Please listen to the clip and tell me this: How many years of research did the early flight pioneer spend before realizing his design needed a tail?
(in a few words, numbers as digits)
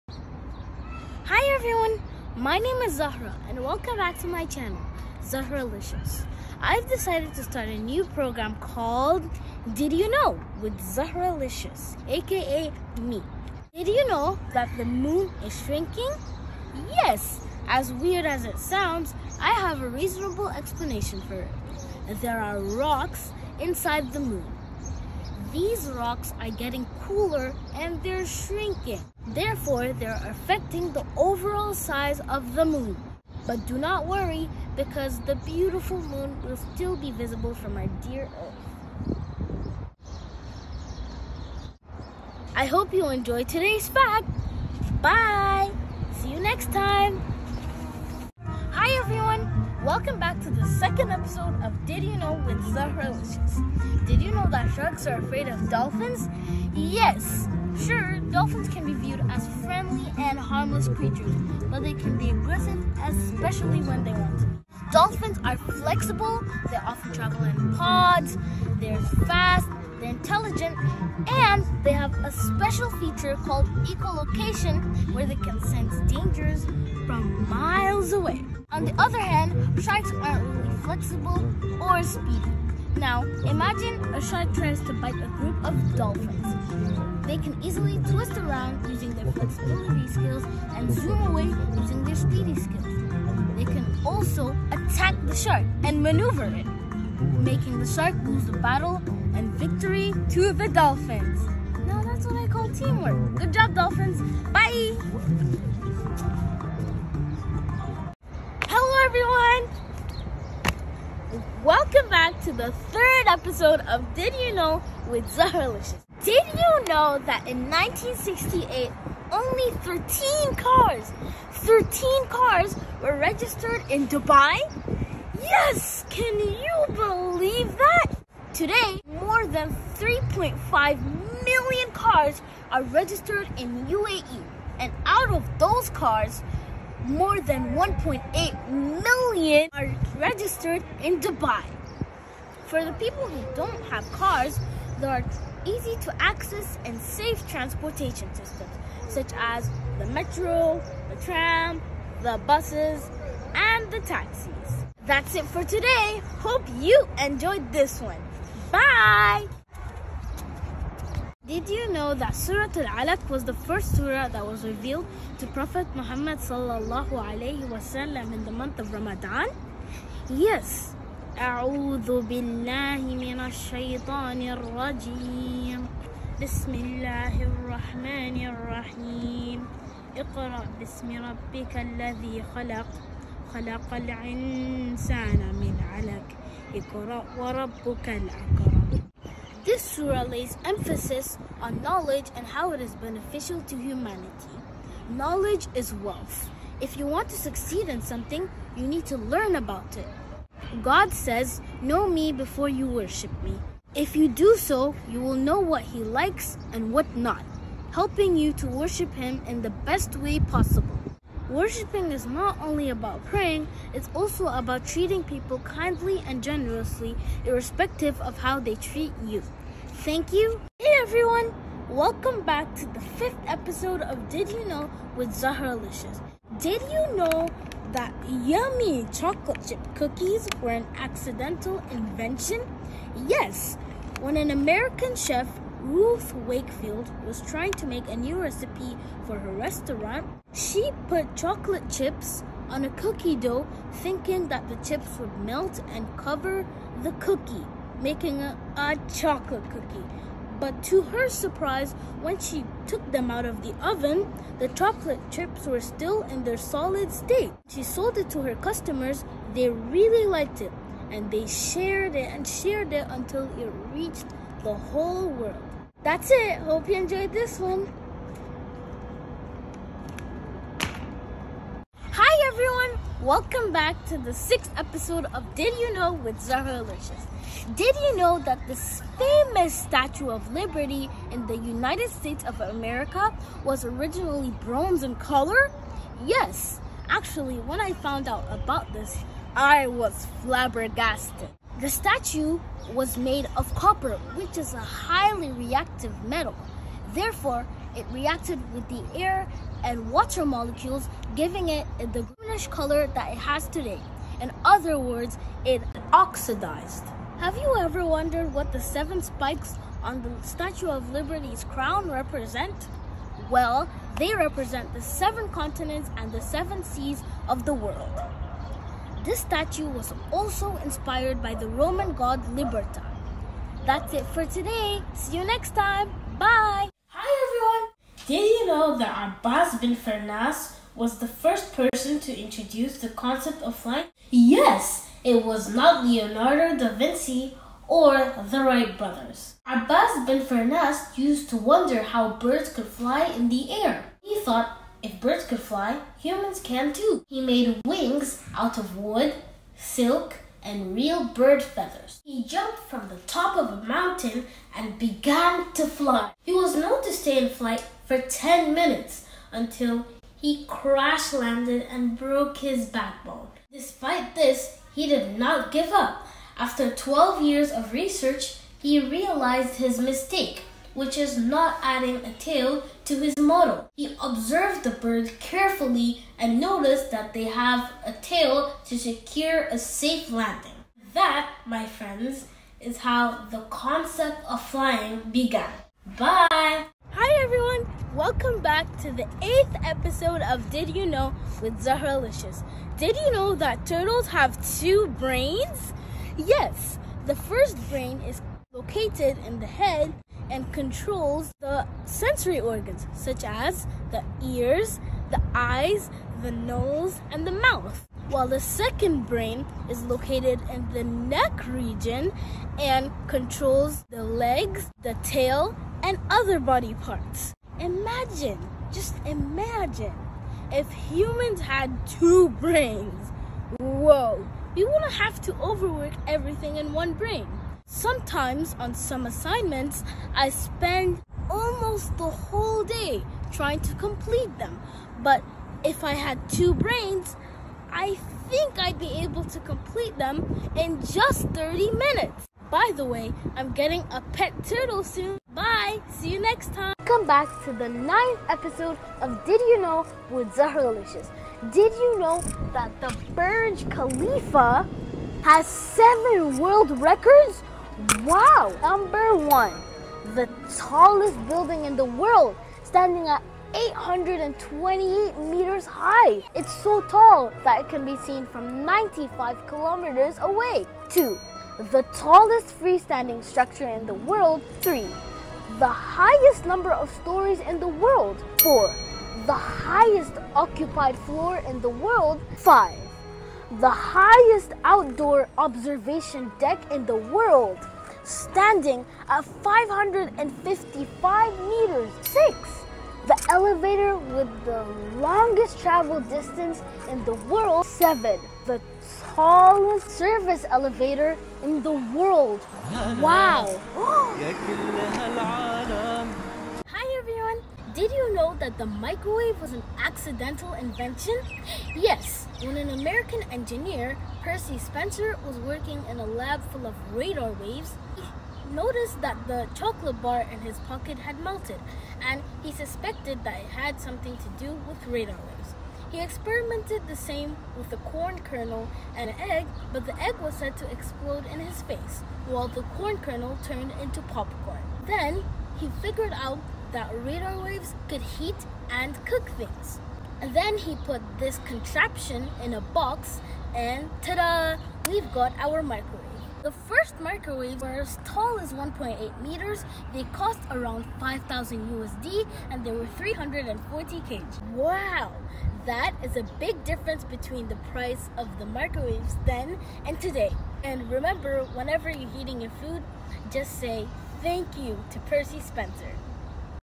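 12.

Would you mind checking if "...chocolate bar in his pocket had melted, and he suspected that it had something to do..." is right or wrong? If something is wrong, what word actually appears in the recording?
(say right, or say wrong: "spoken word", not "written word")
right.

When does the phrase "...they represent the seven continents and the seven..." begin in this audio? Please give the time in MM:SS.
05:14.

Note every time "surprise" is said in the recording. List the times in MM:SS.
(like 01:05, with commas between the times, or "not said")
04:11.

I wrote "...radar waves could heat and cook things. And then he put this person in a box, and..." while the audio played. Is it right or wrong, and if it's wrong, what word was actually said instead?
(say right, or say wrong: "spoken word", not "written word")
wrong: "contraption", not "person".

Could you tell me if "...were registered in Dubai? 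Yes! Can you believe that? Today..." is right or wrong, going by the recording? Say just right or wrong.
right.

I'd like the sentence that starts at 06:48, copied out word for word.
While the second brain is located in the neck region and controls the legs, the tail, and other body parts.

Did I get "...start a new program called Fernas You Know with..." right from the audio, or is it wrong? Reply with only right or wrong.
wrong.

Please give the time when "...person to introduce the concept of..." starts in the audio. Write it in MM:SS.
05:31.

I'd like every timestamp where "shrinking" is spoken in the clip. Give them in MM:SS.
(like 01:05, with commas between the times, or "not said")
00:15, 00:28.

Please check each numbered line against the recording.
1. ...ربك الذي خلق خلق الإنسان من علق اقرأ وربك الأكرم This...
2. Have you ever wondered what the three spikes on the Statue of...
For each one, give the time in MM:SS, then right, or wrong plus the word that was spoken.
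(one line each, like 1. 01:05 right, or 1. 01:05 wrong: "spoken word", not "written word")
1. 03:01 right
2. 05:07 wrong: "seven", not "three".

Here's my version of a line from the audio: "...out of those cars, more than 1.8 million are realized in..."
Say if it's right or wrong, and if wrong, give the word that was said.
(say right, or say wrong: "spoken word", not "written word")
wrong: "registered", not "realized".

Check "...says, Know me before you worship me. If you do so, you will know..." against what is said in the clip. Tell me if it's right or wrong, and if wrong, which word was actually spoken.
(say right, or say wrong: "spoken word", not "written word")
right.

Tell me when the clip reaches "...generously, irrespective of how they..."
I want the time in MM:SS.
03:36.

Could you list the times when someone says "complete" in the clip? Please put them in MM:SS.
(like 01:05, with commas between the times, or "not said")
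07:13, 07:19.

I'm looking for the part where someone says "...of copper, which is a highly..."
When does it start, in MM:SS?
04:53.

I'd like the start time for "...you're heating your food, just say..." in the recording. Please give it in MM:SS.
09:22.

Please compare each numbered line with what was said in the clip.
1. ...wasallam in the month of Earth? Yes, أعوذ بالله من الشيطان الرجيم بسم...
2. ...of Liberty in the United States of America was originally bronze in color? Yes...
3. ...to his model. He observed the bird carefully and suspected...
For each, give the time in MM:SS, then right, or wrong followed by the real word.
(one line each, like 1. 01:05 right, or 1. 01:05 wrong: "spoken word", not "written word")
1. 02:47 wrong: "Ramadan", not "Earth"
2. 04:40 right
3. 06:13 wrong: "noticed", not "suspected".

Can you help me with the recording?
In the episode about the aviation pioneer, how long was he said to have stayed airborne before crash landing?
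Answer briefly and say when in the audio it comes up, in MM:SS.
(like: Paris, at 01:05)
10 minutes, at 05:58.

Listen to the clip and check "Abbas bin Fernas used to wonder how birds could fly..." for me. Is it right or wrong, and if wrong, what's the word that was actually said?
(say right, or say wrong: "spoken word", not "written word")
right.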